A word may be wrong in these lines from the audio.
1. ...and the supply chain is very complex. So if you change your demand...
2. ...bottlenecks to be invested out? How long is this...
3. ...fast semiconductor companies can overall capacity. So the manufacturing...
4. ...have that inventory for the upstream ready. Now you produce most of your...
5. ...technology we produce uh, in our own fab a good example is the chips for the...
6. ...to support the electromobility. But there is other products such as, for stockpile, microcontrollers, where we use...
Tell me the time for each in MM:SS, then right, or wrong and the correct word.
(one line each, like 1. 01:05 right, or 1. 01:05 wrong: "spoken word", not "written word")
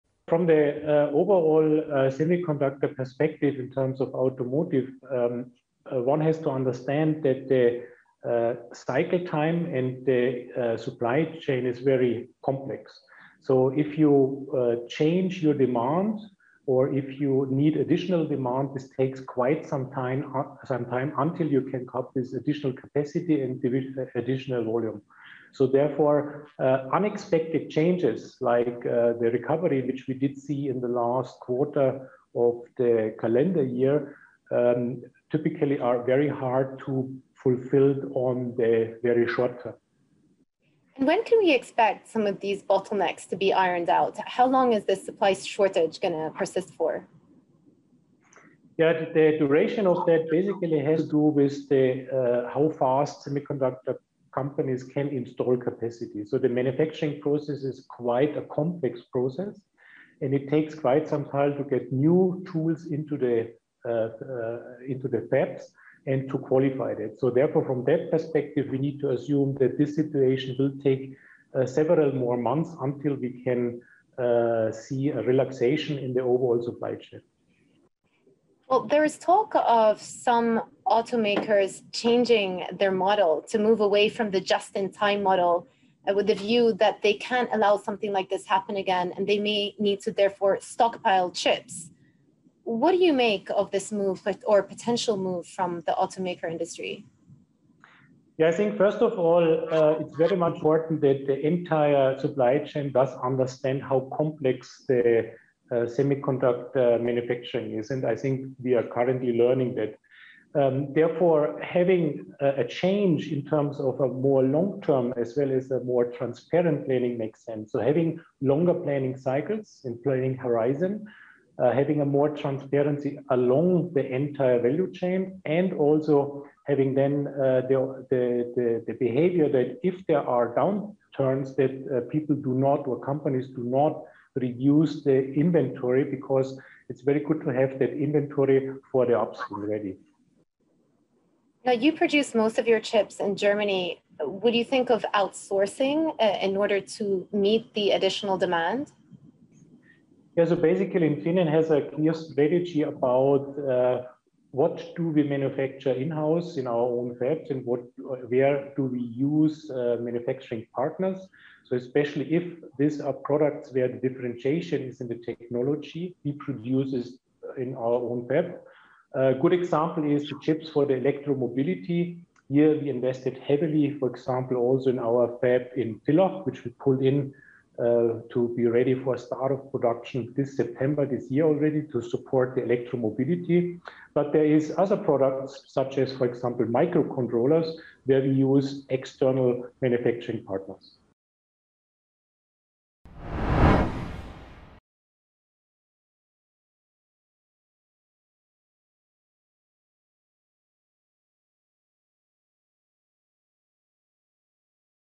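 1. 00:09 right
2. 00:42 wrong: "ironed", not "invested"
3. 00:52 wrong: "install", not "overall"
4. 02:17 right
5. 02:45 right
6. 03:01 wrong: "example", not "stockpile".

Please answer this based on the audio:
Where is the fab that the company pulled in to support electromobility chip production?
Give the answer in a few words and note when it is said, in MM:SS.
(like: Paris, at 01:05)
Villach, at 02:56.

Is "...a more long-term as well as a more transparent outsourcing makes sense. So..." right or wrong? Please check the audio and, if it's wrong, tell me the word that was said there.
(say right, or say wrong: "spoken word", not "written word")
wrong: "planning", not "outsourcing".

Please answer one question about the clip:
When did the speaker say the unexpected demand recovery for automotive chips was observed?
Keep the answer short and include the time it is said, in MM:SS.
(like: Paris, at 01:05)
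Last quarter of the calendar year, at 00:30.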